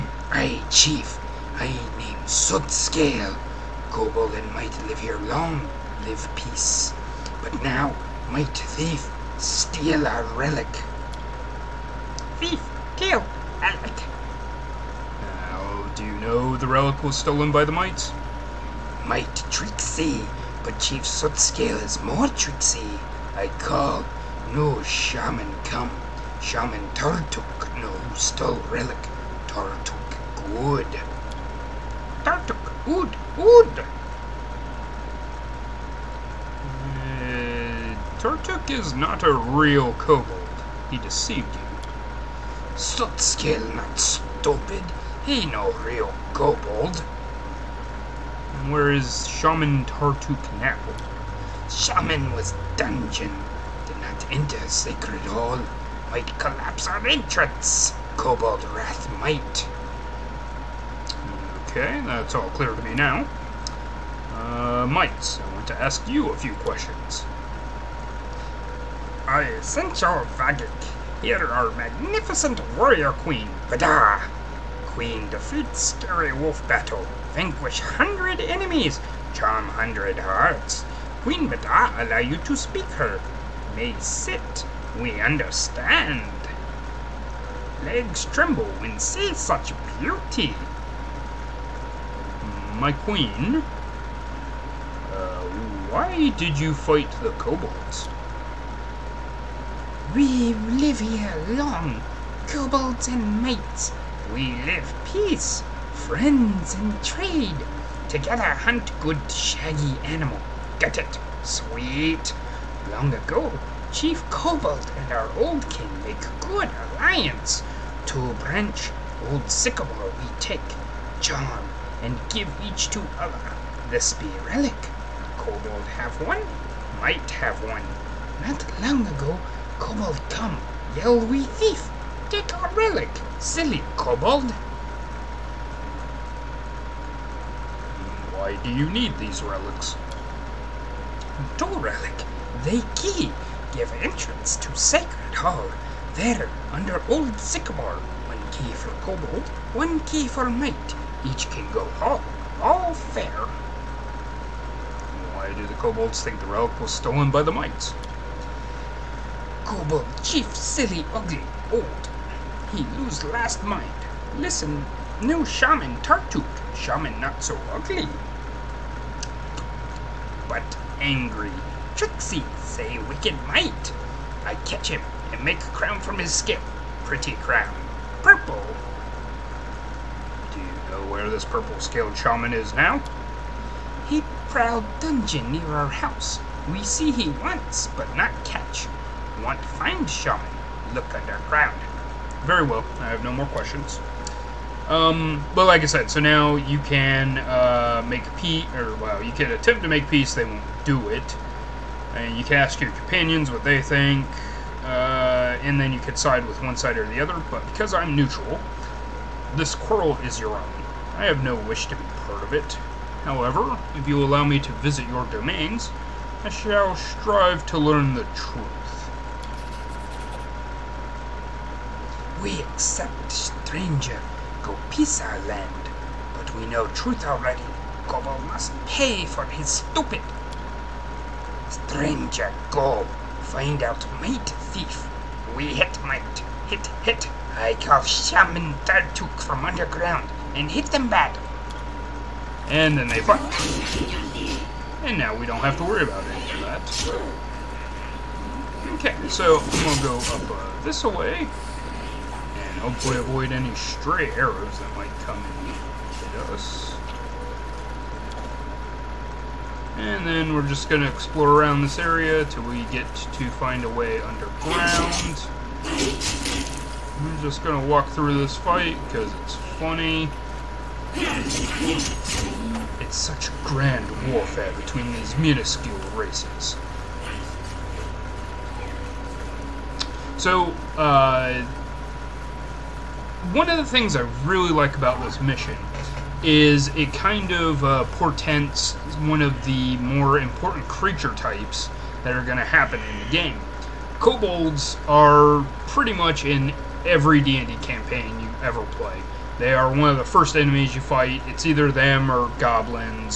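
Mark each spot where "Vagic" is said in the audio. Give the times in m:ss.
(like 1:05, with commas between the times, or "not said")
1:10.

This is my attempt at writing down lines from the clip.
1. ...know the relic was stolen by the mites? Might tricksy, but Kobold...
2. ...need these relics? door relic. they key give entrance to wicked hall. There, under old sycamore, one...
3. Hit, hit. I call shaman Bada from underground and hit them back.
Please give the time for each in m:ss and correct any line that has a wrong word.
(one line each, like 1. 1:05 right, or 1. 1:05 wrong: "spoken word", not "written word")
1. 0:16 wrong: "Chief", not "Kobold"
2. 2:18 wrong: "sacred", not "wicked"
3. 3:56 wrong: "Tartuk", not "Bada".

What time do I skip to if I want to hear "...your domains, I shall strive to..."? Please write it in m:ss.
3:35.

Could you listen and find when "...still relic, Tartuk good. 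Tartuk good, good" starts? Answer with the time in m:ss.
0:28.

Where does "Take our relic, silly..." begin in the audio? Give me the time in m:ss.
2:12.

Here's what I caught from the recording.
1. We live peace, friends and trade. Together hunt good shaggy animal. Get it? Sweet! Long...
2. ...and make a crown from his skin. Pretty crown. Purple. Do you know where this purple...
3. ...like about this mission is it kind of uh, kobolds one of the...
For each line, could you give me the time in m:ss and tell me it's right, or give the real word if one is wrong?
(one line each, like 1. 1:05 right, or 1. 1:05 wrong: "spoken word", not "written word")
1. 1:44 right
2. 2:55 right
3. 4:44 wrong: "portends", not "kobolds".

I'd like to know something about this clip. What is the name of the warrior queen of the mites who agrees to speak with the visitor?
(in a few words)
Badara.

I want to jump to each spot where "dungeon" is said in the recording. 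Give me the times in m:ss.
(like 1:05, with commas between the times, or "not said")
0:52, 3:04.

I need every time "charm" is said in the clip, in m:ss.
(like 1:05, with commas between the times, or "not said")
1:19, 2:01.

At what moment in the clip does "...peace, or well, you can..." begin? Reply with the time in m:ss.
3:18.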